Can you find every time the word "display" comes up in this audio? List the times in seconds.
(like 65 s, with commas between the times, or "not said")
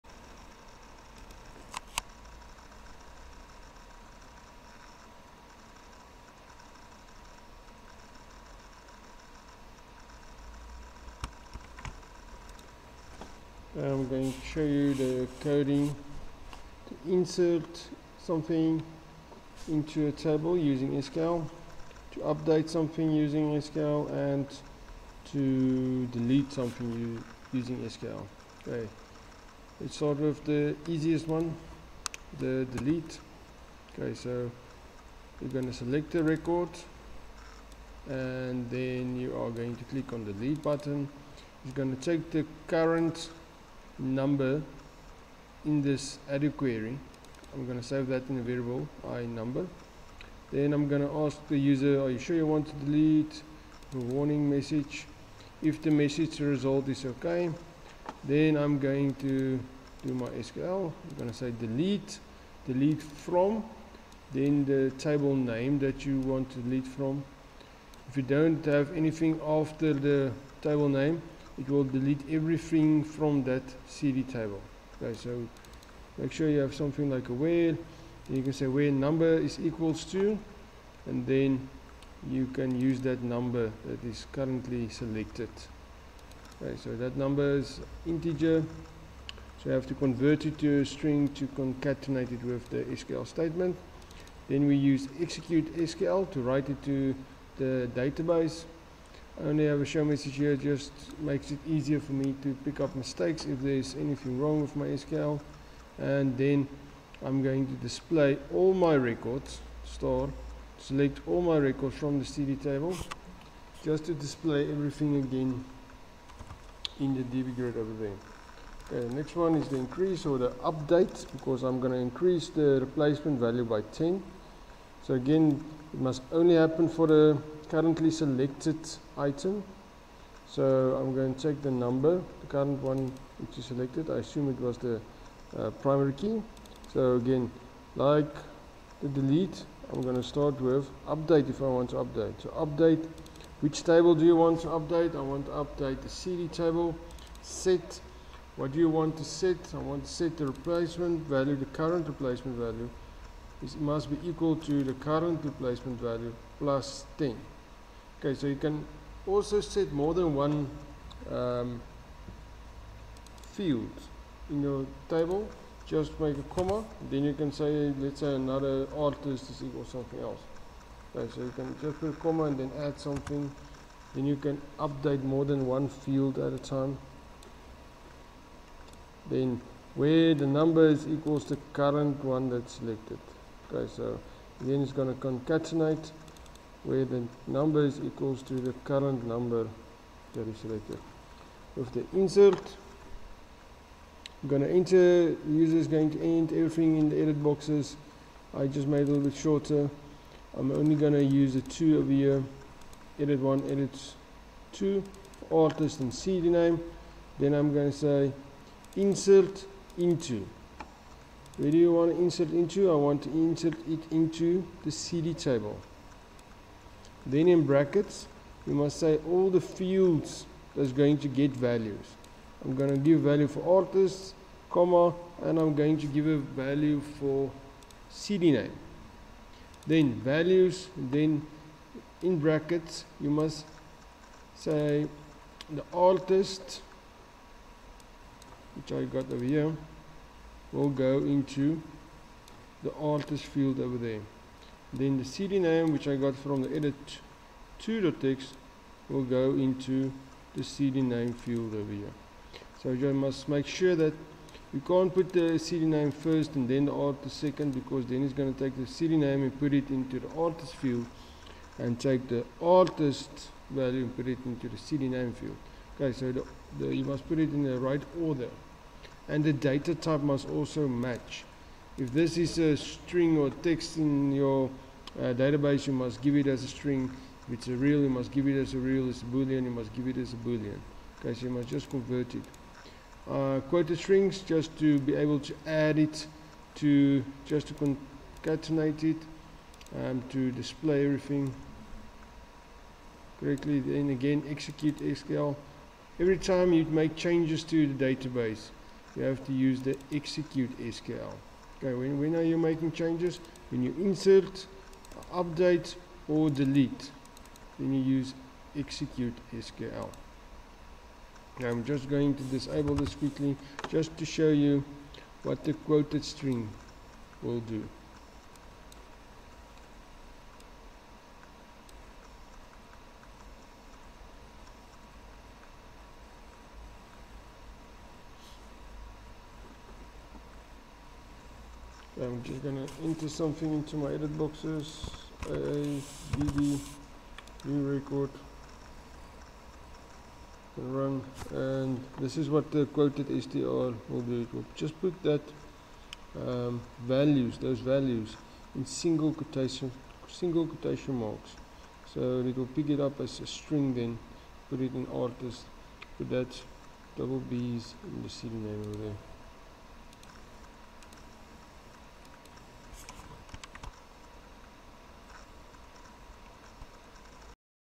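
107 s, 114 s, 290 s.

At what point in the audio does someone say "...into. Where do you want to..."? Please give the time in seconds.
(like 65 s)
209 s.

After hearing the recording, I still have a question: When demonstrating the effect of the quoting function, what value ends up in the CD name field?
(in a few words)
double b's.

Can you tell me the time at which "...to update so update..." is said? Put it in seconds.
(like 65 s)
141 s.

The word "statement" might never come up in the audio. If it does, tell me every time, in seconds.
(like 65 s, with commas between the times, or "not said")
93 s.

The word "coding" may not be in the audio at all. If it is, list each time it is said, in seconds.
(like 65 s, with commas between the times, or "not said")
15 s.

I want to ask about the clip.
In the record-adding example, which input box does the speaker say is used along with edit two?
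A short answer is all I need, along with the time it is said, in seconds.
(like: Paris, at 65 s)
edit one, at 203 s.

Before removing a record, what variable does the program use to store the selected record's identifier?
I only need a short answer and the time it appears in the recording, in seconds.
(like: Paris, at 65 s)
i number, at 49 s.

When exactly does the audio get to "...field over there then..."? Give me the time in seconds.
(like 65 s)
243 s.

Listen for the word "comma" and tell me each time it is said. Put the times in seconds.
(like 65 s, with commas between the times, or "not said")
166 s, 172 s, 224 s.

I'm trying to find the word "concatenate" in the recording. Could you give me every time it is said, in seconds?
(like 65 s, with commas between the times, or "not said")
91 s, 185 s, 287 s.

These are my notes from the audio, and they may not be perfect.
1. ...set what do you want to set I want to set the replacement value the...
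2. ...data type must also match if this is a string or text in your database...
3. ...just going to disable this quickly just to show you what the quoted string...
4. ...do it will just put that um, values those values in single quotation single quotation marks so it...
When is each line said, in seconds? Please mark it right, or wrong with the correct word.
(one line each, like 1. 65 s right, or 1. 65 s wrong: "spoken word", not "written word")
1. 147 s right
2. 269 s right
3. 311 s right
4. 344 s right.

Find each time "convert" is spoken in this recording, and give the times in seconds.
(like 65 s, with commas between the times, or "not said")
89 s, 281 s.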